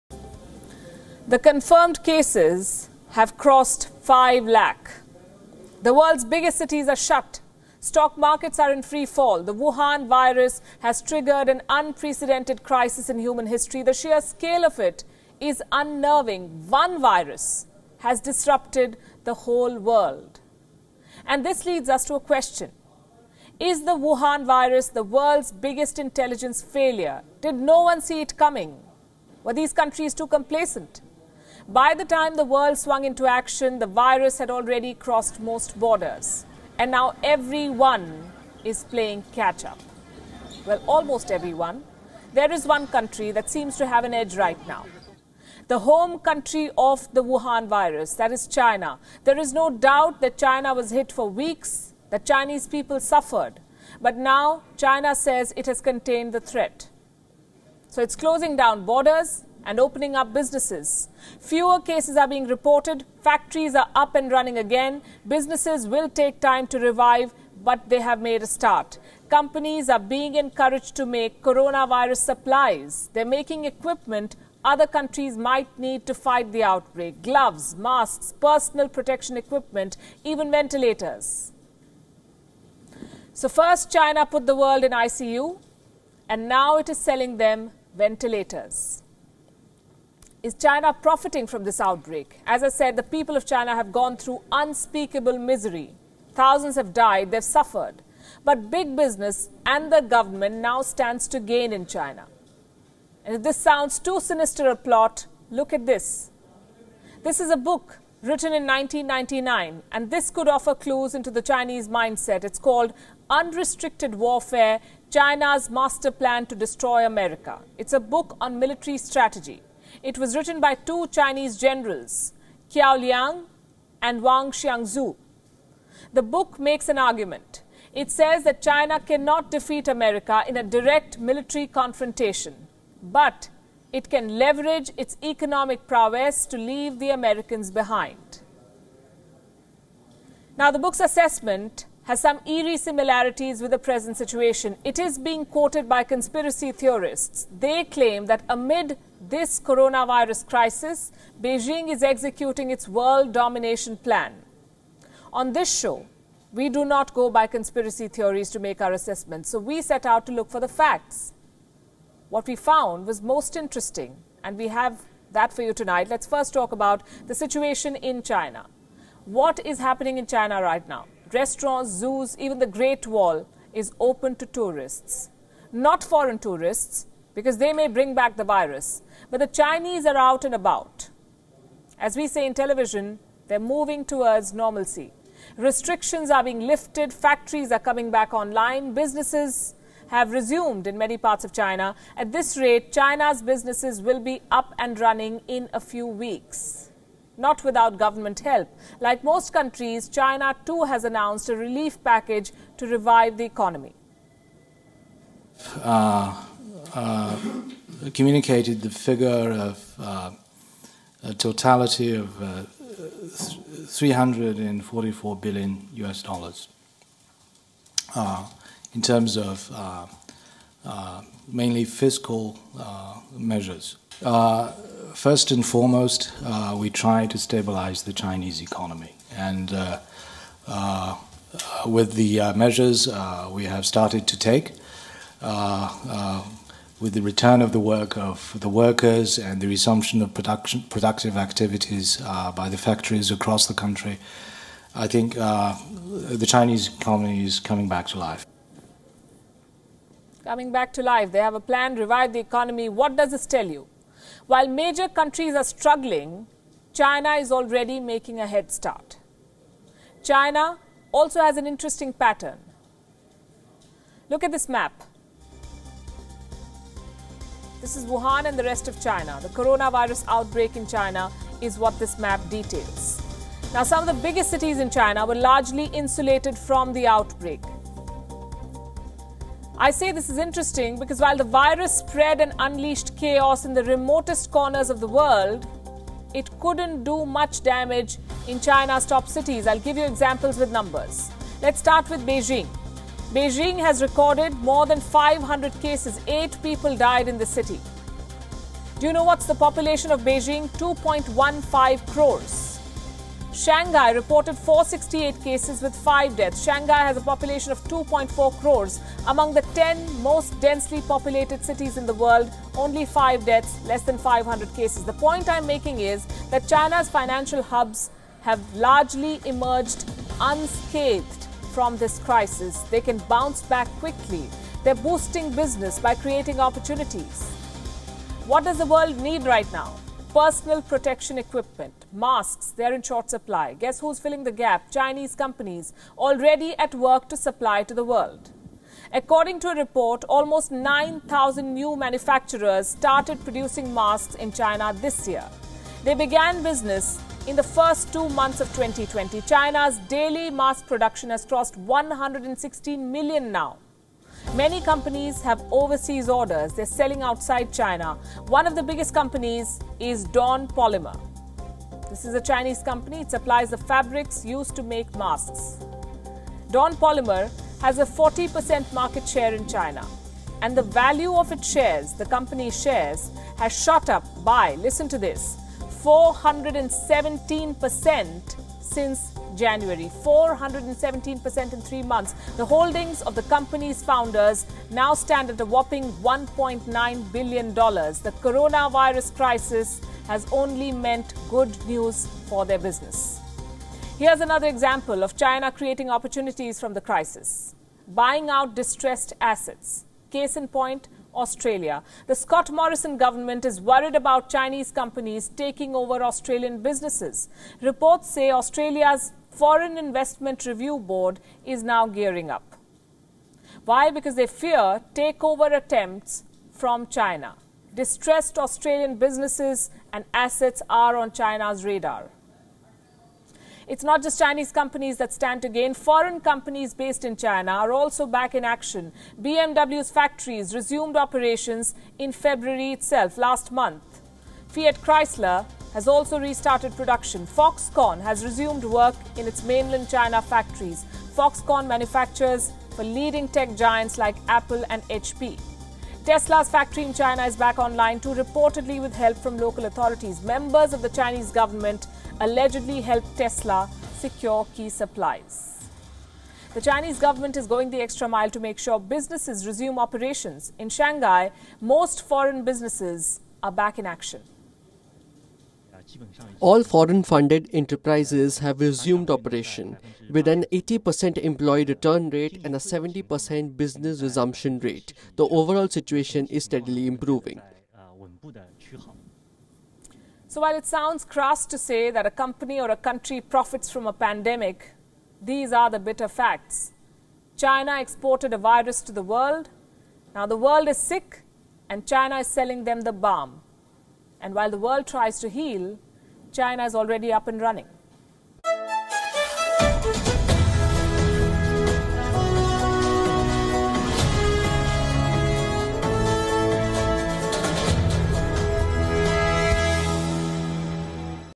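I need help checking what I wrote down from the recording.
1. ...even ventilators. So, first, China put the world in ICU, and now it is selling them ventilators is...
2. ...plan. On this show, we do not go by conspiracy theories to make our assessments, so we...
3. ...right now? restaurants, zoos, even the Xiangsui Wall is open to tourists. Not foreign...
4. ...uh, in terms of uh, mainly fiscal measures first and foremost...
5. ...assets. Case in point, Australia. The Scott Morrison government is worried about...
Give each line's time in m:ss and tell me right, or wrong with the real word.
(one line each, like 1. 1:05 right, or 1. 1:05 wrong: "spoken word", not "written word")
1. 1:20 right
2. 2:33 right
3. 2:50 wrong: "Great", not "Xiangsui"
4. 3:38 right
5. 6:39 right.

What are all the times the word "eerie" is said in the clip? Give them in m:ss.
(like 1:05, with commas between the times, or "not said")
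2:22.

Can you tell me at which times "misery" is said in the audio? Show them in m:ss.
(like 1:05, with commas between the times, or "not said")
1:35.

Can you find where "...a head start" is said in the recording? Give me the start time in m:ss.
4:18.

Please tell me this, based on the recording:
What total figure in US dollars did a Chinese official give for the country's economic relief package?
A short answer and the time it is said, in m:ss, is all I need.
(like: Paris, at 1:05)
344 billion US dollars, at 3:33.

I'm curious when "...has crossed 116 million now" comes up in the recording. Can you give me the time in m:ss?
5:51.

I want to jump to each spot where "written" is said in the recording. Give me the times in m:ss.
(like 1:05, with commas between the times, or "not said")
1:48, 2:00.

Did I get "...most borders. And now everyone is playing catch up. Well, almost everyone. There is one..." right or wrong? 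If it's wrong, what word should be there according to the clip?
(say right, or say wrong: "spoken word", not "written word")
right.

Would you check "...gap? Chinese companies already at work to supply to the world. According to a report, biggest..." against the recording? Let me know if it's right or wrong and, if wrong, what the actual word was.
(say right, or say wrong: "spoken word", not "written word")
wrong: "almost", not "biggest".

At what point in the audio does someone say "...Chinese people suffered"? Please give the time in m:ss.
0:52.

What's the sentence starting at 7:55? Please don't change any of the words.
The overall situation is steadily improving.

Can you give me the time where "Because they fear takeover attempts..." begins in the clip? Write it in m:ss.
6:54.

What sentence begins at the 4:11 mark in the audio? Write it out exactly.
They have a plan, to revive the economy.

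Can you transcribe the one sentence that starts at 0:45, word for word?
The home country of the Wuhan virus, that is China.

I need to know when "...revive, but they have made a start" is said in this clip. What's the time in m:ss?
1:06.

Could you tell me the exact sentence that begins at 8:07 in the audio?
China exported a virus to the world.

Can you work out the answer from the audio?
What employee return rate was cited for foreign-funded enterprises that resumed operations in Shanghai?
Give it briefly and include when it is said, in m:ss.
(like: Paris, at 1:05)
80%, at 7:50.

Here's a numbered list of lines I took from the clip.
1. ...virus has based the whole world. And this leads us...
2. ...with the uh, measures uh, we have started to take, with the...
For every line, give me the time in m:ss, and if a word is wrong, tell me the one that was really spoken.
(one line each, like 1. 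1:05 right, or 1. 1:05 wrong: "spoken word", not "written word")
1. 0:16 wrong: "disrupted", not "based"
2. 3:51 right.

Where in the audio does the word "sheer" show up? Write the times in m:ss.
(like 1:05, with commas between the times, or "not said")
0:13.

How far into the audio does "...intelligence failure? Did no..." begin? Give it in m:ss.
0:25.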